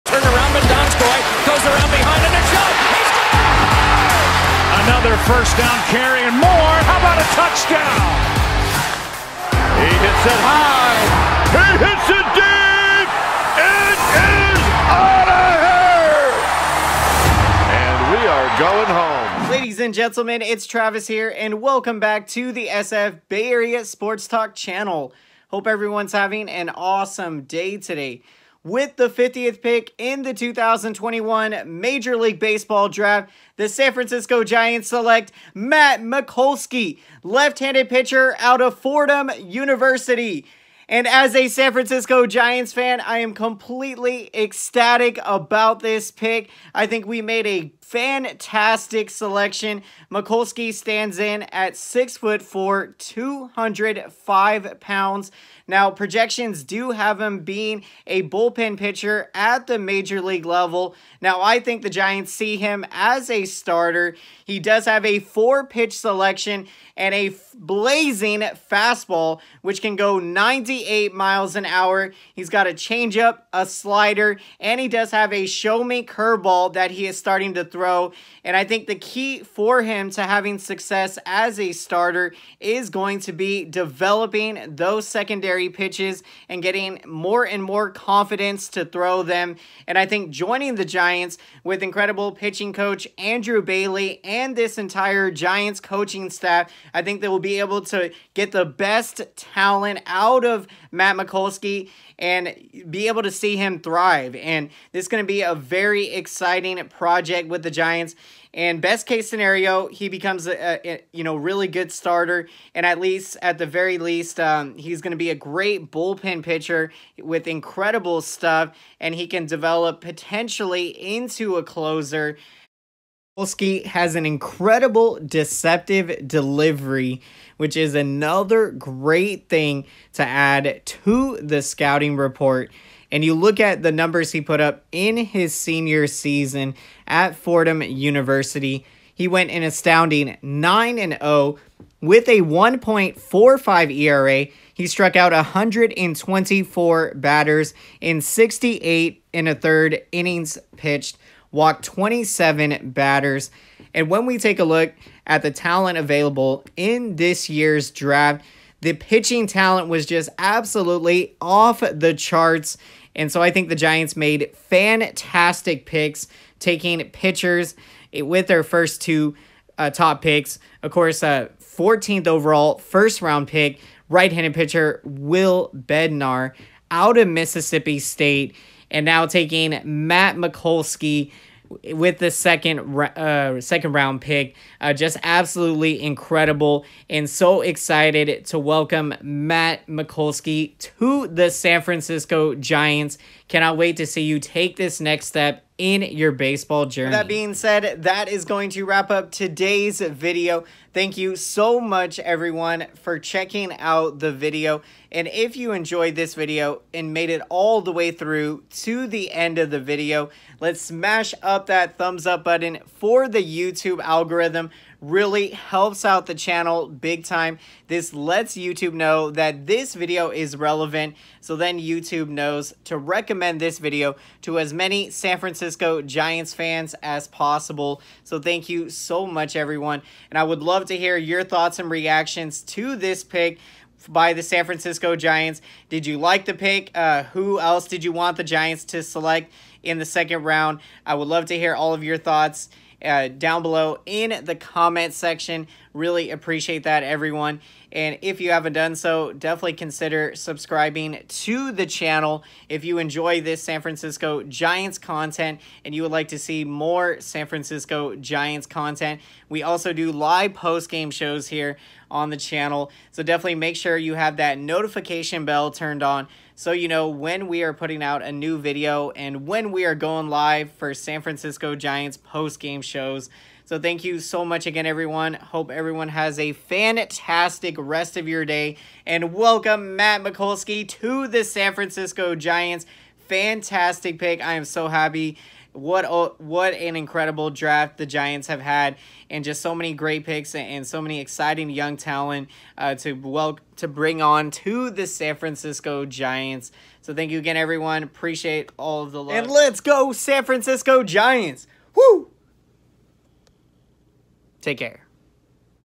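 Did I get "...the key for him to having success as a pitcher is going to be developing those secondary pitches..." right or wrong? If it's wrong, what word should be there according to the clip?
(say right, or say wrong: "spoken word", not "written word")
wrong: "starter", not "pitcher".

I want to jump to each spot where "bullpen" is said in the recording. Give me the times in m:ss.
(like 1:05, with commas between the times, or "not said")
0:58, 1:55.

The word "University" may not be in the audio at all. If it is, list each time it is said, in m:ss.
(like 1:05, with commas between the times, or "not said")
0:39, 2:17.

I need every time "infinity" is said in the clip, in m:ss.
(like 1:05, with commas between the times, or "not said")
not said.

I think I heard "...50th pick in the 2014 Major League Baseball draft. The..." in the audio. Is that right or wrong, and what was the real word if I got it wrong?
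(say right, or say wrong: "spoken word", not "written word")
wrong: "2021", not "2014".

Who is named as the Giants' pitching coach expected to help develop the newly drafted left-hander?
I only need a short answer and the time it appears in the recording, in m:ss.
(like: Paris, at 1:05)
Andrew Bailey, at 1:33.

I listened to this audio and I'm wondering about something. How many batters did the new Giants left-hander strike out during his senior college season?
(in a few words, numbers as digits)
124.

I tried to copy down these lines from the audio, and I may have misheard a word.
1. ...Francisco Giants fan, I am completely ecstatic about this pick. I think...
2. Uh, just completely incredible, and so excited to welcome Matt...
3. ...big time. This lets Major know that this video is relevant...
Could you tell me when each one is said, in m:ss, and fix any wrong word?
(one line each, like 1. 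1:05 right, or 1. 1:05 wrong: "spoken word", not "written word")
1. 0:41 right
2. 3:04 wrong: "absolutely", not "completely"
3. 3:36 wrong: "YouTube", not "Major".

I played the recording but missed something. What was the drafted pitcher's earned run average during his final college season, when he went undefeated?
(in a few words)
1.45.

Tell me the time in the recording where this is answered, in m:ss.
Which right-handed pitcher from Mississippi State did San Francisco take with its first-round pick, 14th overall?
2:55.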